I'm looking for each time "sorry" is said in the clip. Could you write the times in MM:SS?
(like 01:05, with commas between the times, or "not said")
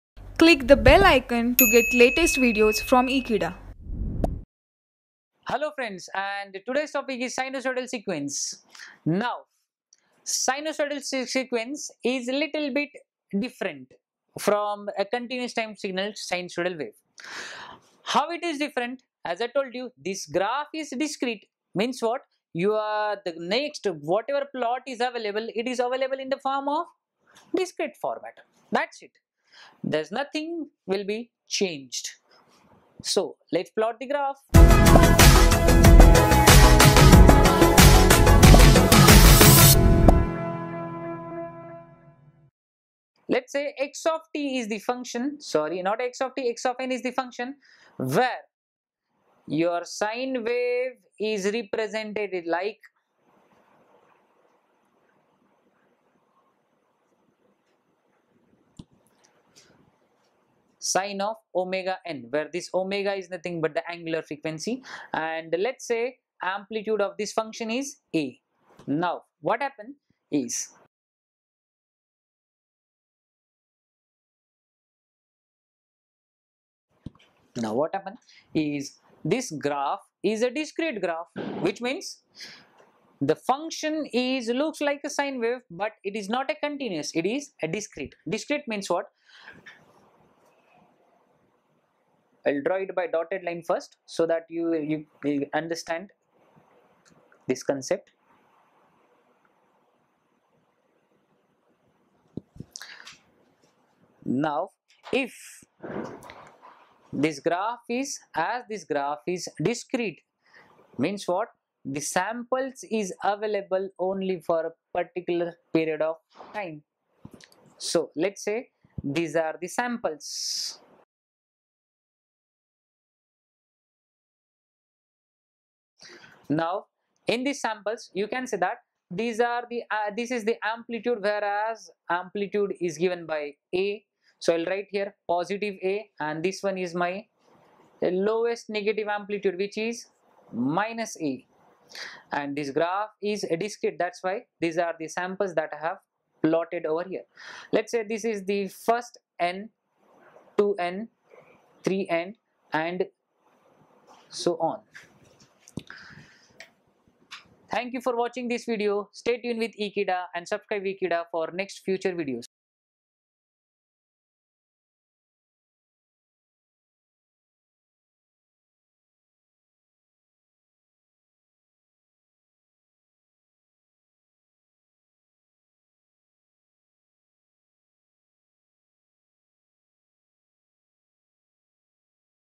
00:45.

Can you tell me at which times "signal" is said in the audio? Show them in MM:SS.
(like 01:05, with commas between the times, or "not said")
00:15.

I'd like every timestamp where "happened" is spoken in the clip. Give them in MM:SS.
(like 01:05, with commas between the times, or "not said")
01:09, 01:17.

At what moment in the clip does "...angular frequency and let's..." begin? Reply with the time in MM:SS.
01:03.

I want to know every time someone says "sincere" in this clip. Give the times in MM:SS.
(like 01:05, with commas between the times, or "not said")
not said.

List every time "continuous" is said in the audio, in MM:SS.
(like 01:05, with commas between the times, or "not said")
00:15, 01:26.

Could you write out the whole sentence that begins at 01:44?
Now, if this graph is, as this graph is discrete, means what?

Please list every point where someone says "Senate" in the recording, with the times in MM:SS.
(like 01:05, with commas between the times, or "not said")
not said.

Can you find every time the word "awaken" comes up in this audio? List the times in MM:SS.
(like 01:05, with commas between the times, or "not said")
not said.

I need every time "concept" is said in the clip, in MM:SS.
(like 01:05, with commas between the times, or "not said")
01:37.